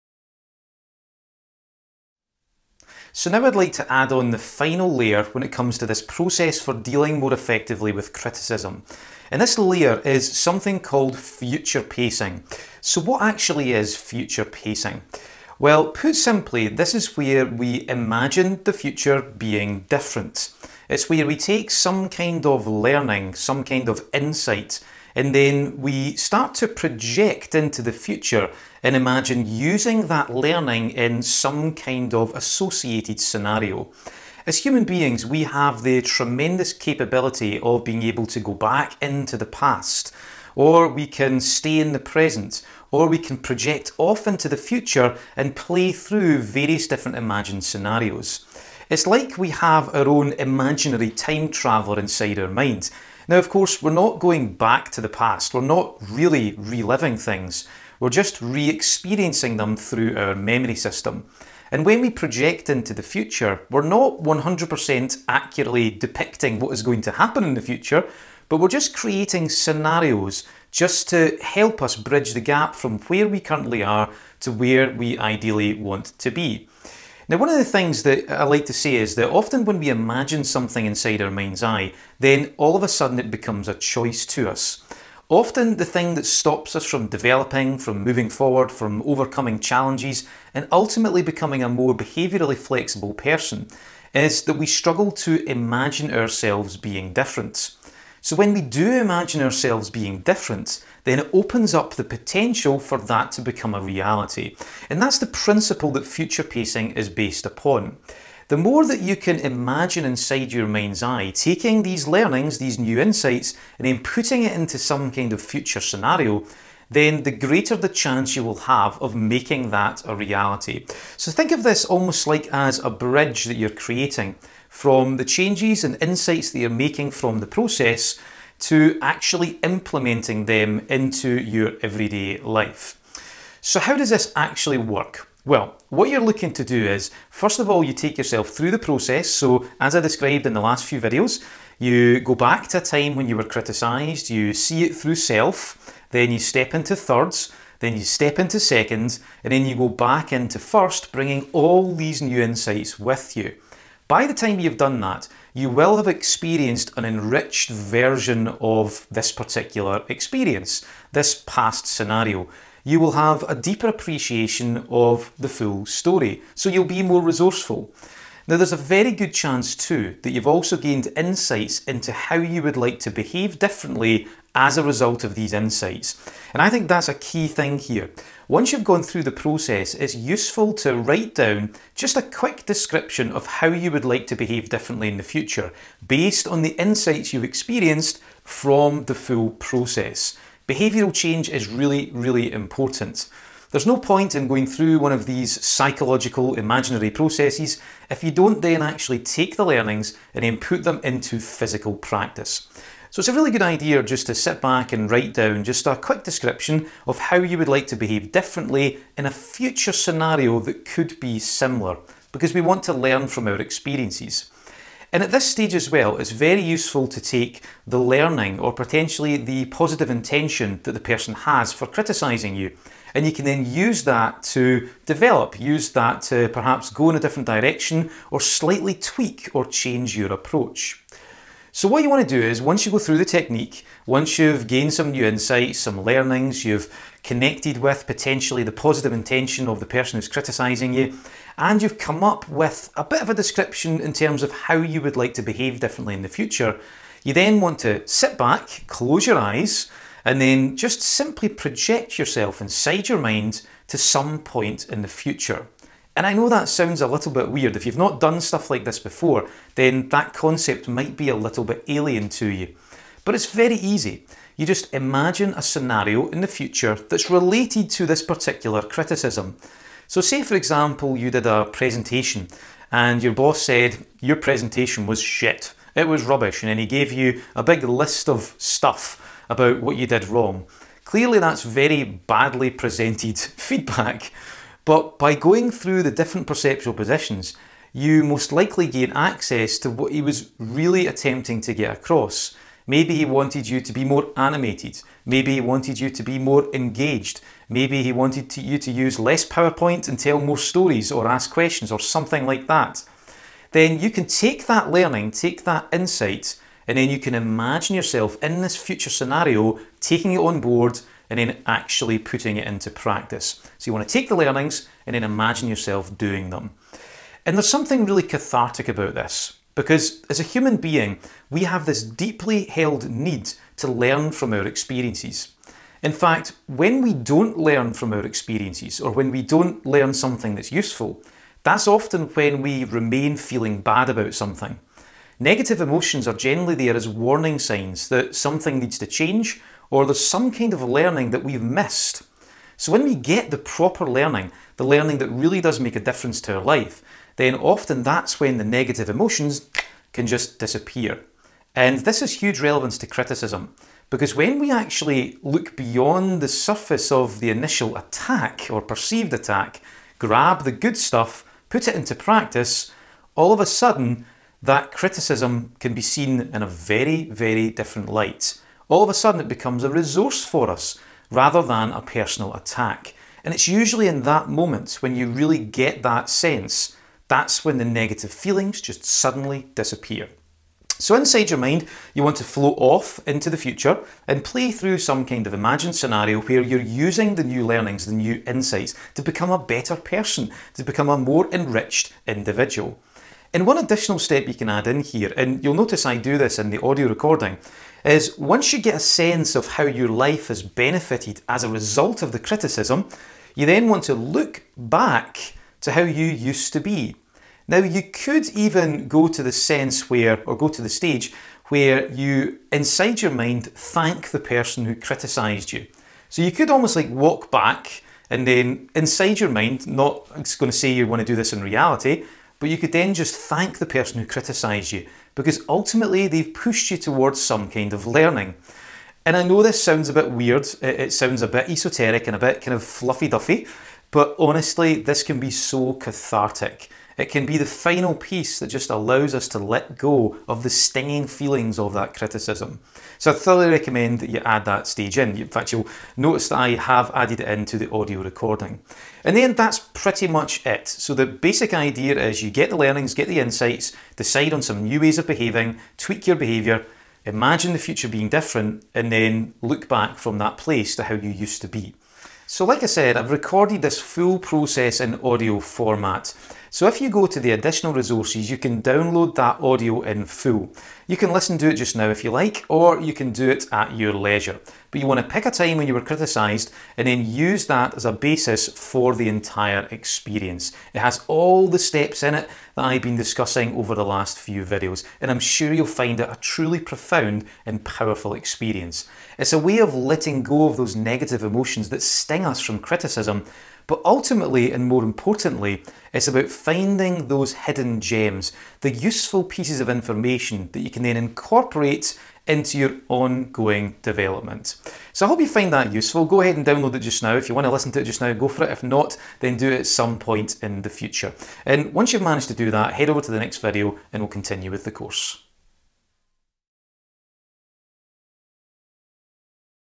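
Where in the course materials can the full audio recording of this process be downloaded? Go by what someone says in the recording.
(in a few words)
Additional resources.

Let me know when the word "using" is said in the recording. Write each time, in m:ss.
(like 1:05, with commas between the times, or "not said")
0:29, 6:26.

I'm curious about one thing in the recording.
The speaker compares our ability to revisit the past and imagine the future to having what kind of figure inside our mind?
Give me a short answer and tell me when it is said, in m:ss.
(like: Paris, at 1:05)
Imaginary time traveller, at 0:50.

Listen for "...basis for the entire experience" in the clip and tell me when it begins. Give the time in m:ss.
7:58.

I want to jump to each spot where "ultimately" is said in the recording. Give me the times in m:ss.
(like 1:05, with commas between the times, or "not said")
1:30, 7:05, 8:14.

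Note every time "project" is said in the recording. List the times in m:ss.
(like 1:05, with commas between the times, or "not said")
0:26, 0:43, 1:02, 4:11.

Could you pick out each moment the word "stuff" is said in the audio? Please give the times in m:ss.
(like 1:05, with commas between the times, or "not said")
4:18, 4:38, 6:00.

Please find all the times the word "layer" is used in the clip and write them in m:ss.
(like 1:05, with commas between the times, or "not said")
0:04, 0:09.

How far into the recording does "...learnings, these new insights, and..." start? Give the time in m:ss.
1:52.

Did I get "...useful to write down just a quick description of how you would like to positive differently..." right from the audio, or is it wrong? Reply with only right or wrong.
wrong.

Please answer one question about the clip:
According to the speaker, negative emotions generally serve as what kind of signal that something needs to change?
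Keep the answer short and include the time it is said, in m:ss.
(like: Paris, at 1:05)
Warning signs, at 5:37.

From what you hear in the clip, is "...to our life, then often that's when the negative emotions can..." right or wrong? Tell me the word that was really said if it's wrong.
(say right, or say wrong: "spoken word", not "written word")
right.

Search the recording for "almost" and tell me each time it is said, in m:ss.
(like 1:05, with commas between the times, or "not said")
2:01, 6:56.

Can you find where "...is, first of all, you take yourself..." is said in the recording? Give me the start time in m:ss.
2:16.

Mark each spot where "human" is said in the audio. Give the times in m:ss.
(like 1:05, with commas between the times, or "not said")
0:34, 5:20.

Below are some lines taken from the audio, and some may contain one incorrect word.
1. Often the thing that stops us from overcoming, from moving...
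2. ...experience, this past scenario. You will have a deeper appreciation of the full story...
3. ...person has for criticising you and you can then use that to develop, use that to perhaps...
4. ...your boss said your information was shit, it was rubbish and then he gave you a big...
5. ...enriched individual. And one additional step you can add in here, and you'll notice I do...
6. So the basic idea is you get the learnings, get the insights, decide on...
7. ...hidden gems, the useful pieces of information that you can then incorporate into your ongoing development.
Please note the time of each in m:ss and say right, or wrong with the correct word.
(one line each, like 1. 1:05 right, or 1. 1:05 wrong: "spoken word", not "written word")
1. 1:25 wrong: "developing", not "overcoming"
2. 2:40 right
3. 3:41 right
4. 4:33 wrong: "presentation", not "information"
5. 6:31 right
6. 7:30 right
7. 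8:17 right.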